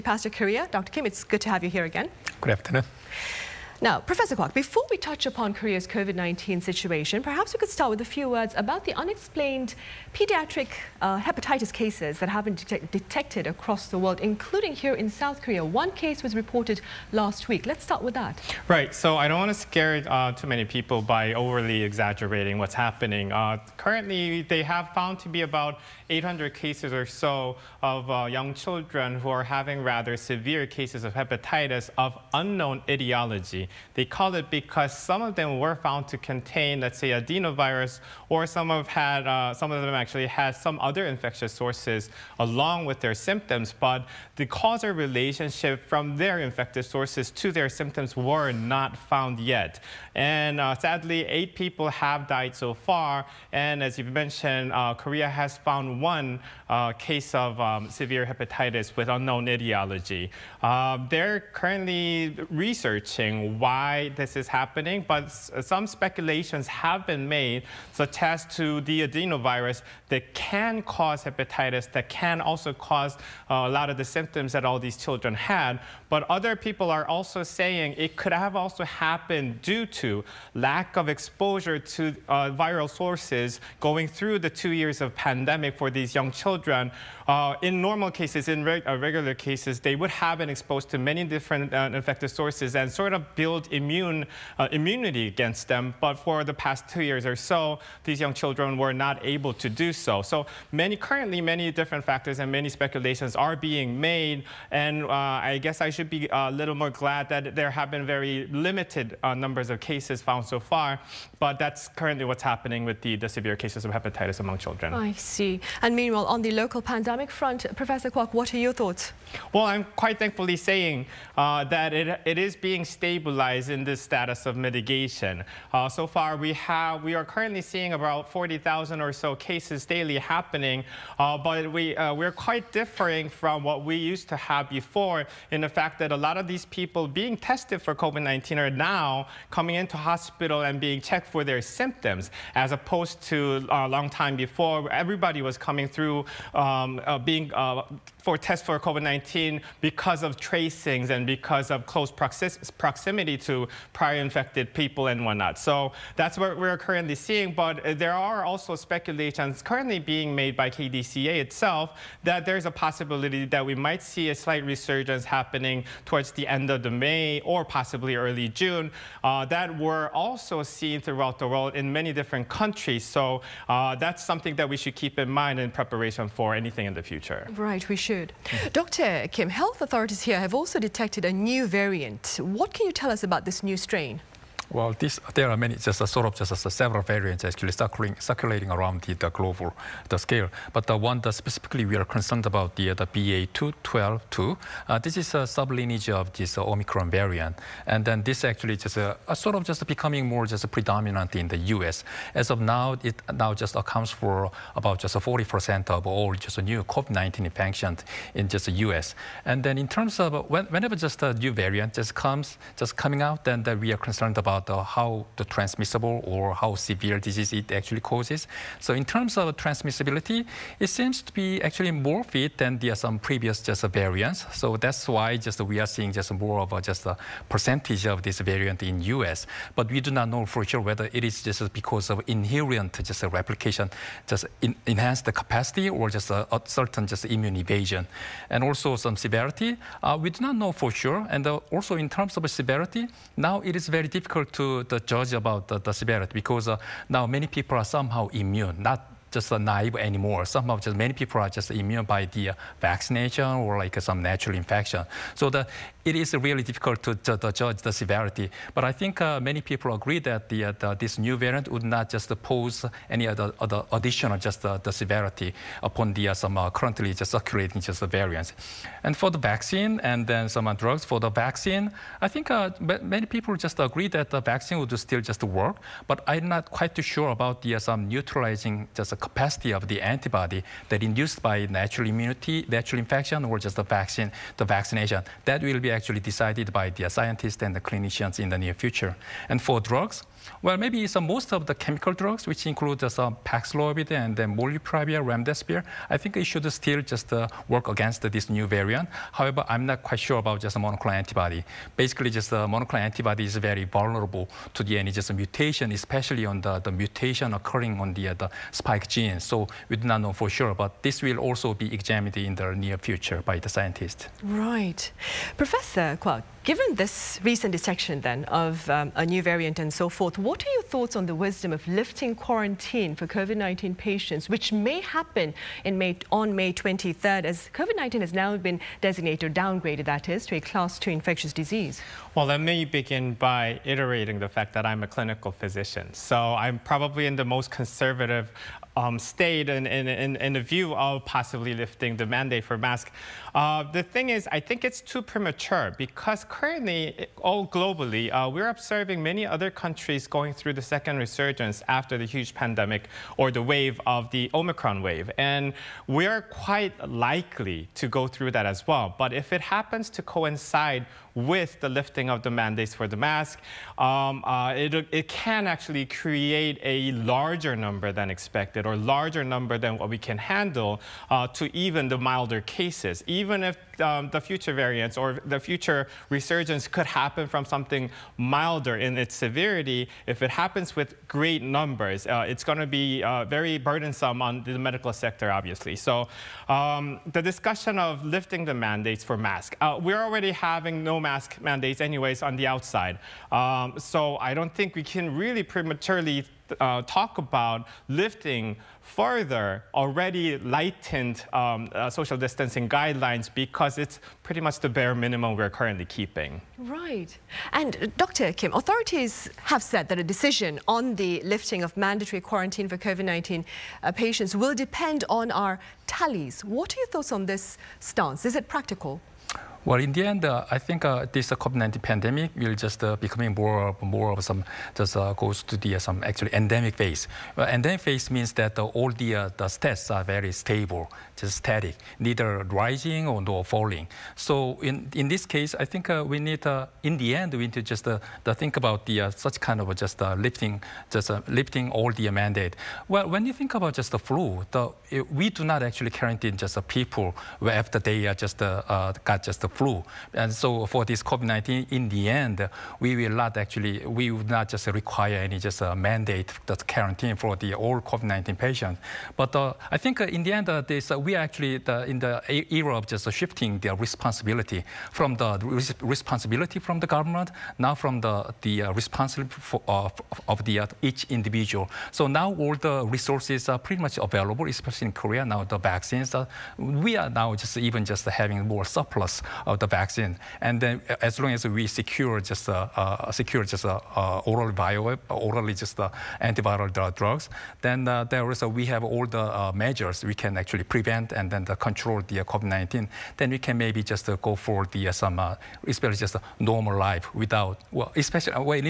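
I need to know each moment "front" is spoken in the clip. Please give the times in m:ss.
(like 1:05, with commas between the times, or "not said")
1:57.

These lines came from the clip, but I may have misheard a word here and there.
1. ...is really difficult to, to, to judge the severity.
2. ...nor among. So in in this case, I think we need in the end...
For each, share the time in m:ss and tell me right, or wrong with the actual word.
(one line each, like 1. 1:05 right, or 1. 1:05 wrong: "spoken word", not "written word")
1. 4:16 right
2. 7:13 wrong: "falling", not "among".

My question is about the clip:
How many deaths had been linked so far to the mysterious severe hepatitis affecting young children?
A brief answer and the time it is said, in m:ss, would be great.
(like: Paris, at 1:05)
8, at 0:51.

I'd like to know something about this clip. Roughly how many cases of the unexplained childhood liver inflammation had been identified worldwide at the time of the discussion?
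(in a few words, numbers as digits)
800.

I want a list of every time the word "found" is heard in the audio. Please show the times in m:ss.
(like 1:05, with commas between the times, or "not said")
0:24, 0:35, 0:48, 0:55, 1:50.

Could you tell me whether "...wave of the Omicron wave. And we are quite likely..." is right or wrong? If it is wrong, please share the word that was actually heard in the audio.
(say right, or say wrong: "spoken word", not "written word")
right.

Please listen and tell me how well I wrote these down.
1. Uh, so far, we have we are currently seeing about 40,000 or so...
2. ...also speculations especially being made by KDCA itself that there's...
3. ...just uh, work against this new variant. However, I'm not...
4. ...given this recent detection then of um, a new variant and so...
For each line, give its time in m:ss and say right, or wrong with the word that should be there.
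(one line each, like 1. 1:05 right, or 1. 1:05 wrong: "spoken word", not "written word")
1. 2:05 right
2. 2:38 wrong: "currently", not "especially"
3. 4:57 right
4. 5:16 right.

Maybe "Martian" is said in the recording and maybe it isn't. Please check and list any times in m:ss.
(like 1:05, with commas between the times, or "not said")
not said.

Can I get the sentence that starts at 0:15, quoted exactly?
One case was reported last week.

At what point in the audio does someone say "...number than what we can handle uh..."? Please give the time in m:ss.
6:09.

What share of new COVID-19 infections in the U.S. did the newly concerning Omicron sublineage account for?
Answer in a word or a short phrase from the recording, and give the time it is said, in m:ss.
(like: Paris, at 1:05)
40%, at 3:25.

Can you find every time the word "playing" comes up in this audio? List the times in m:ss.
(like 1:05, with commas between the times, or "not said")
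not said.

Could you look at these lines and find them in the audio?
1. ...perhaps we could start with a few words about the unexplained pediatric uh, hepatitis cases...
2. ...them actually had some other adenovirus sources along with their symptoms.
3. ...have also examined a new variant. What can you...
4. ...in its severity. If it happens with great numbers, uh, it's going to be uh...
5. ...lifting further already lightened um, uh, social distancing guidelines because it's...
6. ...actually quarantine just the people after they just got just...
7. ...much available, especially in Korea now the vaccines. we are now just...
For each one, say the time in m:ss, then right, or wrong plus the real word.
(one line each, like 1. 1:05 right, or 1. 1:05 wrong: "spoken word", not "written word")
1. 0:07 right
2. 0:39 wrong: "infectious", not "adenovirus"
3. 3:00 wrong: "detected", not "examined"
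4. 6:18 right
5. 6:38 right
6. 7:25 right
7. 7:54 right.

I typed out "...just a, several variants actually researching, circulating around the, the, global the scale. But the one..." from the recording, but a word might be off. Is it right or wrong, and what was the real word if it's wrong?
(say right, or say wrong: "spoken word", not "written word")
wrong: "circulating", not "researching".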